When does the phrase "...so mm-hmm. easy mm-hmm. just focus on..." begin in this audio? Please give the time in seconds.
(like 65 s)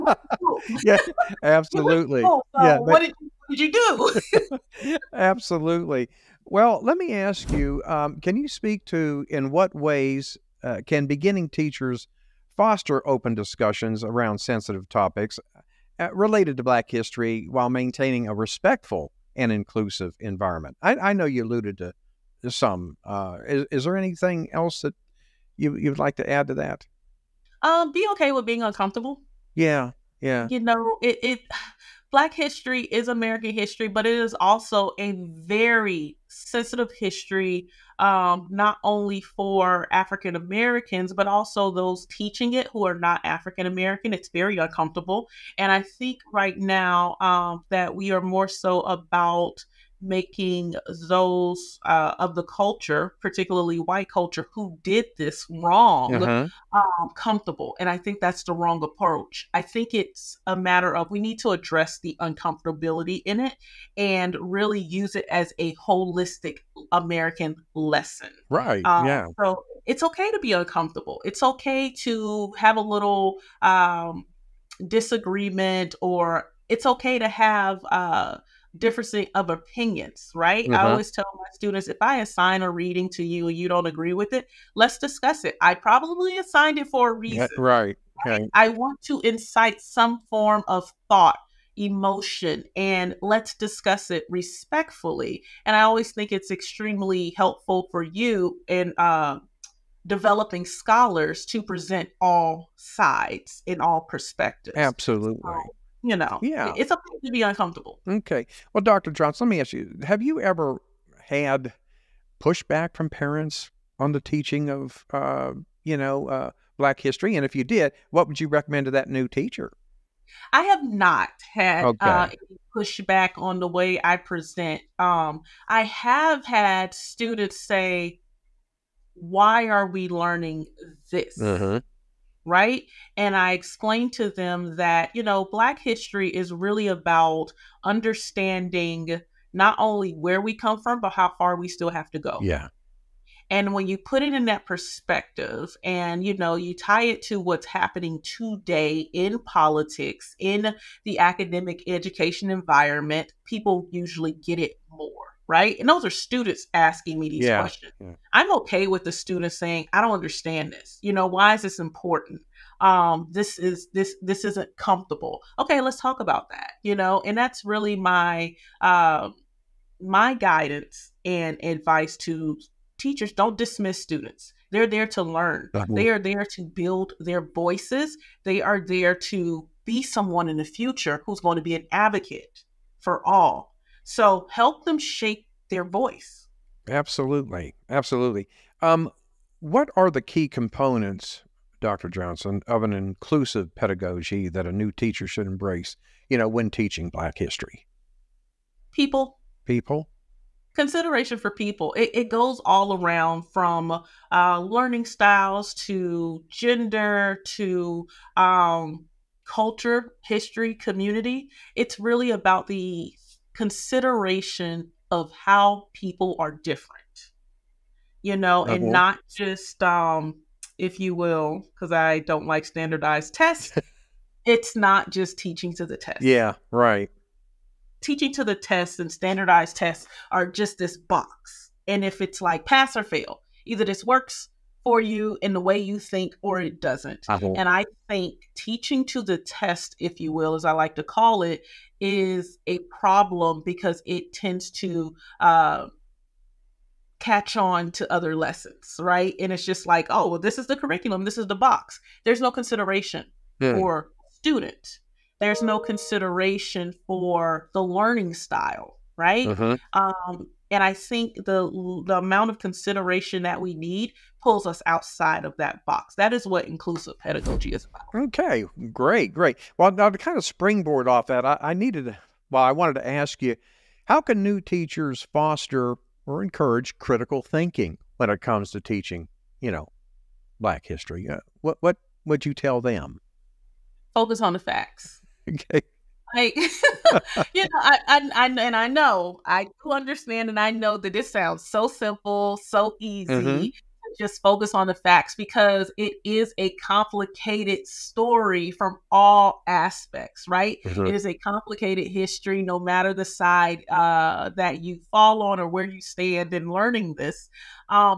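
292 s.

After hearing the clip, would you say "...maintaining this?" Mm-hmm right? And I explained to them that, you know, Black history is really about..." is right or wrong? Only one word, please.
wrong.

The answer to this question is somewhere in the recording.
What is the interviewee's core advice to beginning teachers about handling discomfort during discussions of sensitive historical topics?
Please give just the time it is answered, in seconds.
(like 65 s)
27 s.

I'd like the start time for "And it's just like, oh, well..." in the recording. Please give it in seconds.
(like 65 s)
249 s.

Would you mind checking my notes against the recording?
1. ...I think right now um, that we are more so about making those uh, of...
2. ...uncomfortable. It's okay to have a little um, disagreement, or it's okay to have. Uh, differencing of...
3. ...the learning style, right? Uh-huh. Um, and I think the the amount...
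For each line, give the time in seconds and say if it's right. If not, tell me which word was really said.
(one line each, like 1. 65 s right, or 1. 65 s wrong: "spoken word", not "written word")
1. 45 s right
2. 70 s right
3. 257 s right.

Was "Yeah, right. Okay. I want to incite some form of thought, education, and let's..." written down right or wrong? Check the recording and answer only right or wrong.
wrong.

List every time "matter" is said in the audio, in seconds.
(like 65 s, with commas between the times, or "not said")
60 s, 302 s.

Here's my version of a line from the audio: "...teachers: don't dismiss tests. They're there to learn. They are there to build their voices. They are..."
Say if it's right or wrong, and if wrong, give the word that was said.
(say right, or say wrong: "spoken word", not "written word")
wrong: "students", not "tests".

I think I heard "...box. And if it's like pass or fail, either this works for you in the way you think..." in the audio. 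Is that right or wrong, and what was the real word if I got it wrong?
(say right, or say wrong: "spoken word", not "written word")
right.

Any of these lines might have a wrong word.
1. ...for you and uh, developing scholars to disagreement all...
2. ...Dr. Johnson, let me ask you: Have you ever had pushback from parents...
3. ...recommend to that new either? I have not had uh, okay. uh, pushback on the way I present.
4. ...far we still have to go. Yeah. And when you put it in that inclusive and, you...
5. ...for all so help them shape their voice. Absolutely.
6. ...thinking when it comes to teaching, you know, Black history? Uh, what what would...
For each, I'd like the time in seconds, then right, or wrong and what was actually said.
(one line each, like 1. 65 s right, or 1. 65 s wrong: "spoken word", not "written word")
1. 97 s wrong: "present", not "disagreement"
2. 108 s right
3. 118 s wrong: "teacher", not "either"
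4. 141 s wrong: "perspective", not "inclusive"
5. 182 s right
6. 277 s right.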